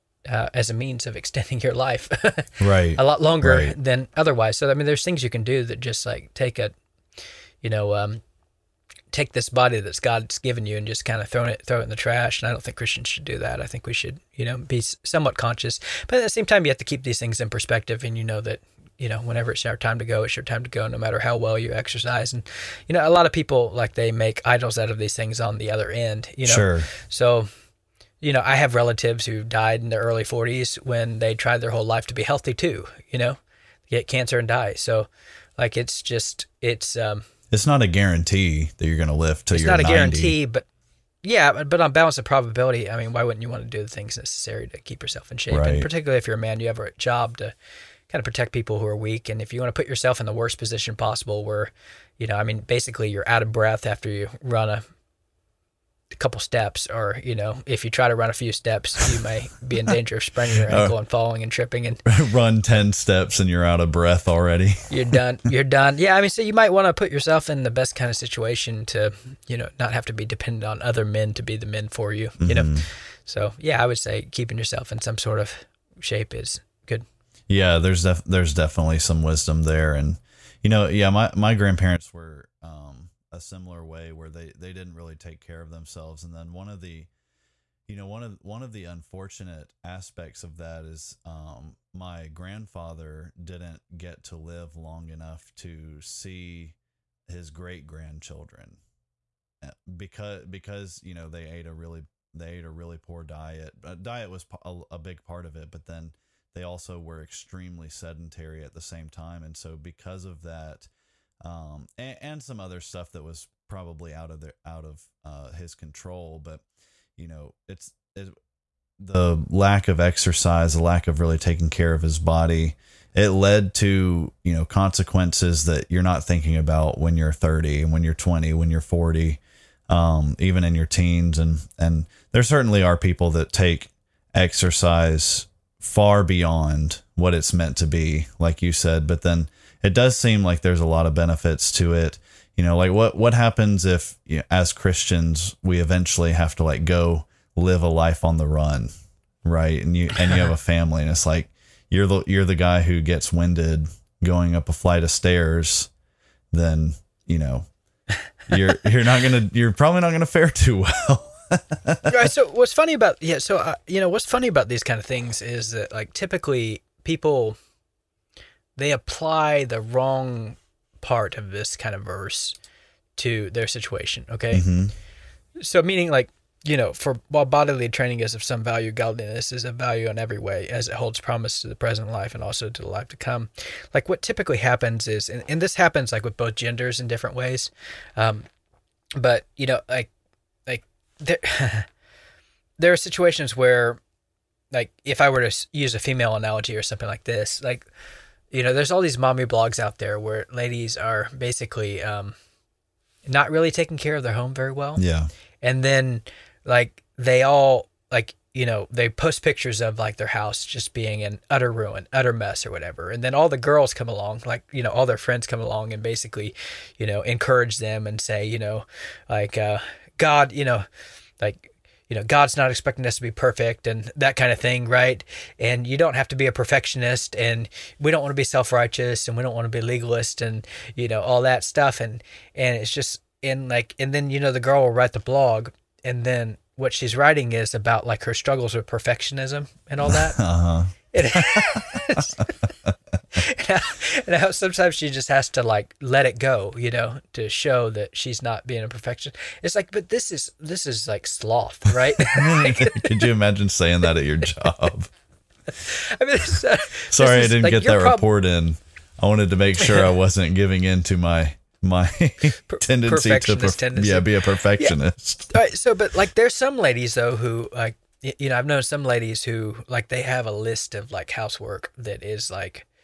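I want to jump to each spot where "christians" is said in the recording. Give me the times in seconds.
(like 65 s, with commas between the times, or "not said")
12 s, 144 s.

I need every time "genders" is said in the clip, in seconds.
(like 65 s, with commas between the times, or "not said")
186 s.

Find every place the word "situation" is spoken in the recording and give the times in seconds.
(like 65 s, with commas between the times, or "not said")
68 s, 173 s, 192 s.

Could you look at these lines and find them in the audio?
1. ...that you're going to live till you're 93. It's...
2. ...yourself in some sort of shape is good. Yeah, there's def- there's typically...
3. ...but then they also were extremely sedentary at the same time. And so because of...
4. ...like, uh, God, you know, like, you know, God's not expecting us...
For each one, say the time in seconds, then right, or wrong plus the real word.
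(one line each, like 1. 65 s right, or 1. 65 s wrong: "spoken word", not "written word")
1. 38 s wrong: "90", not "93"
2. 74 s wrong: "definitely", not "typically"
3. 105 s right
4. 219 s right.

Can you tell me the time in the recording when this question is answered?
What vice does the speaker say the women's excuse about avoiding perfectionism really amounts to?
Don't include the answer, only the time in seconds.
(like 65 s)
251 s.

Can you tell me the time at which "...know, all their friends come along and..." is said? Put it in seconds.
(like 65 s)
214 s.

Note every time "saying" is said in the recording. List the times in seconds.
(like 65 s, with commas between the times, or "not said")
253 s.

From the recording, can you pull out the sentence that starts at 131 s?
And, and there certainly are people that take exercise far beyond what it's meant to be, like you said.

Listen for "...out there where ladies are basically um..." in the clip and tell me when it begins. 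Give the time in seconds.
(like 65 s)
199 s.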